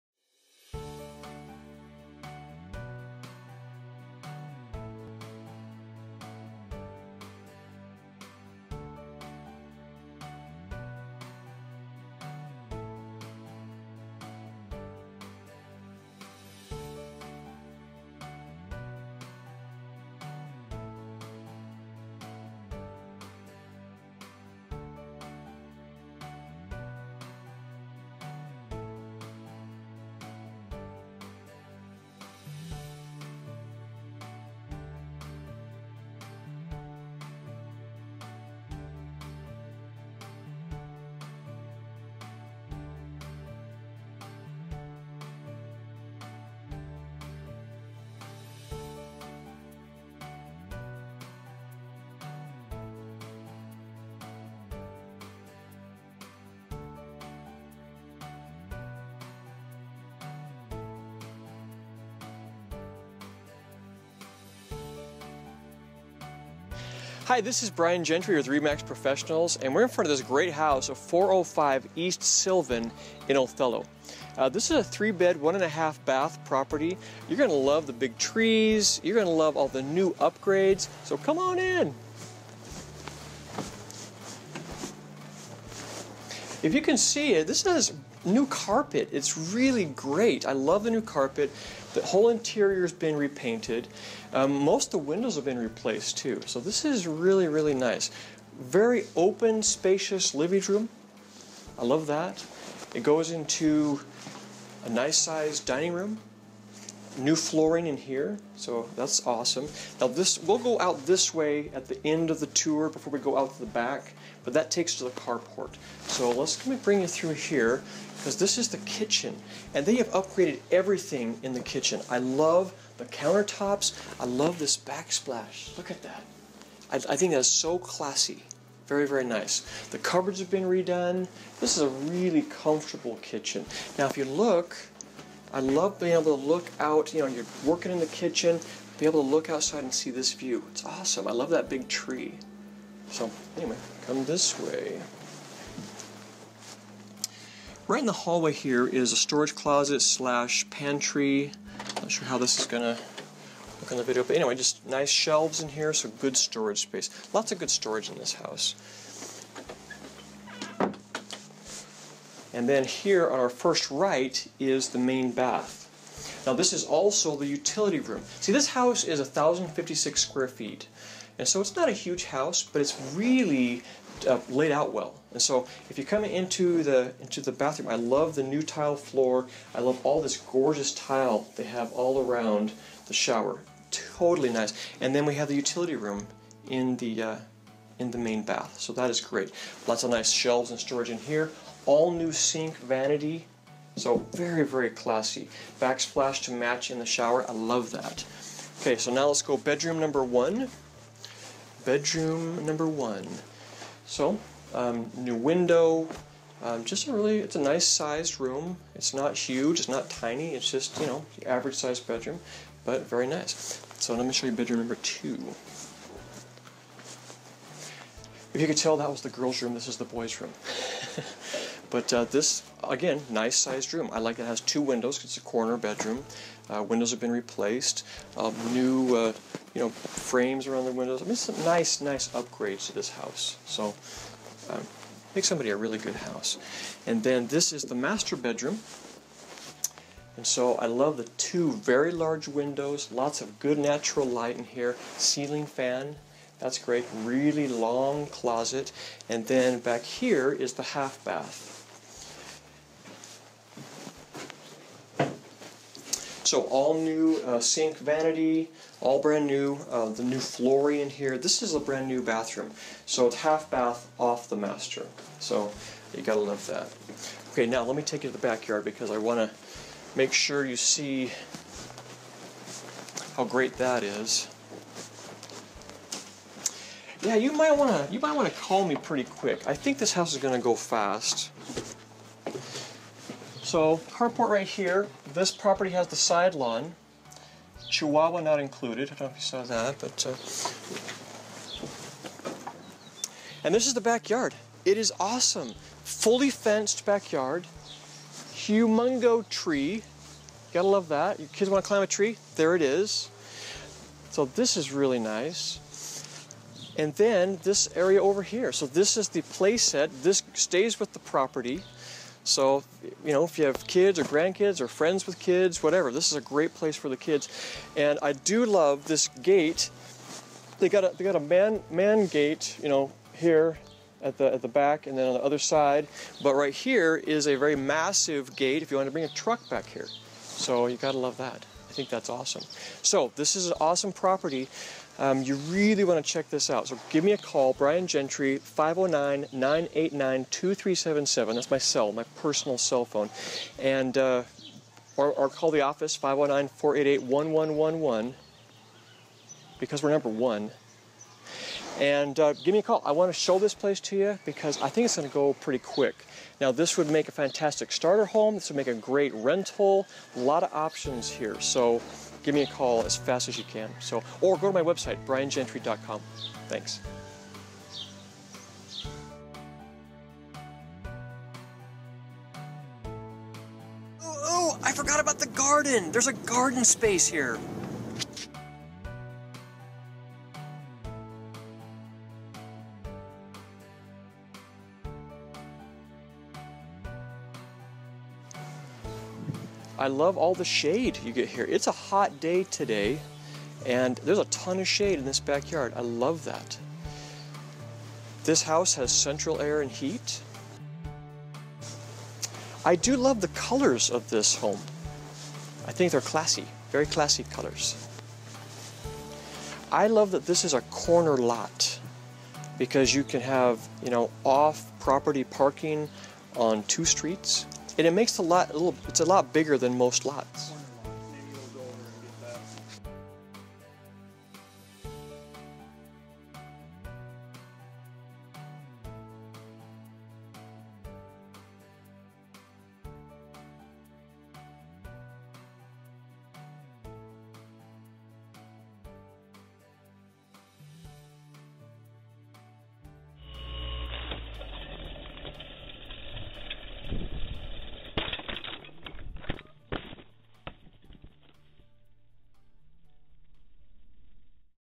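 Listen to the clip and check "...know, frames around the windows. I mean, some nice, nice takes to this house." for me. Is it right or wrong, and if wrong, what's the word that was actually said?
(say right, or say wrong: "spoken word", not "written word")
wrong: "upgrades", not "takes".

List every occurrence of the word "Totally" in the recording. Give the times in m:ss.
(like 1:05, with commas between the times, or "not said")
3:03.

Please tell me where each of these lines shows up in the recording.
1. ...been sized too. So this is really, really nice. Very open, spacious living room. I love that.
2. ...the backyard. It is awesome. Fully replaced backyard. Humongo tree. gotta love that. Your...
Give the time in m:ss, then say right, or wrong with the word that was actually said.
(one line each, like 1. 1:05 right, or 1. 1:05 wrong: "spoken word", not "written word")
1. 1:35 wrong: "replaced", not "sized"
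2. 4:53 wrong: "fenced", not "replaced".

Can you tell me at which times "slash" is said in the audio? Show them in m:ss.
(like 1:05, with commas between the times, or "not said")
2:30.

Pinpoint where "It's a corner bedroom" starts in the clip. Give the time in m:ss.
3:45.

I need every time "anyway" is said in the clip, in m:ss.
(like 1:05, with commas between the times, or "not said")
2:23, 2:34.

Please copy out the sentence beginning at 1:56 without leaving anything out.
So let's let me bring you through here because this is the kitchen, and they have upgraded everything in the kitchen.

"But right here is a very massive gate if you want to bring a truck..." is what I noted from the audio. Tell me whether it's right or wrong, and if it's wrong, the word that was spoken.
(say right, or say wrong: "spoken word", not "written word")
right.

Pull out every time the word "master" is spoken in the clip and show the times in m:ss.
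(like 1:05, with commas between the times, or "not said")
3:57, 4:24.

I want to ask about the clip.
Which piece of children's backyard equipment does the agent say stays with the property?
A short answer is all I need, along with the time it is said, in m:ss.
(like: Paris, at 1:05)
Play set, at 5:09.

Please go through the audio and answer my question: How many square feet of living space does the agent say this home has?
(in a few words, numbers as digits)
1,056.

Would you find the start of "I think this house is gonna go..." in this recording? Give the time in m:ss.
4:39.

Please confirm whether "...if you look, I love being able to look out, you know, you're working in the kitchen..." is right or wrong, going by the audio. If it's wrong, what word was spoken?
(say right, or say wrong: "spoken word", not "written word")
right.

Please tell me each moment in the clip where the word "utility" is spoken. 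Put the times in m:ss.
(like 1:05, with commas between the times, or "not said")
2:47, 3:05.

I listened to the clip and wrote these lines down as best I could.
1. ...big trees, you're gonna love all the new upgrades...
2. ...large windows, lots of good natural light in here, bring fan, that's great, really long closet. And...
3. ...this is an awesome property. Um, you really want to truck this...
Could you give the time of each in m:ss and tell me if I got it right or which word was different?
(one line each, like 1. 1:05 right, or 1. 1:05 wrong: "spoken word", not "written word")
1. 1:17 right
2. 4:02 wrong: "ceiling", not "bring"
3. 5:33 wrong: "check", not "truck".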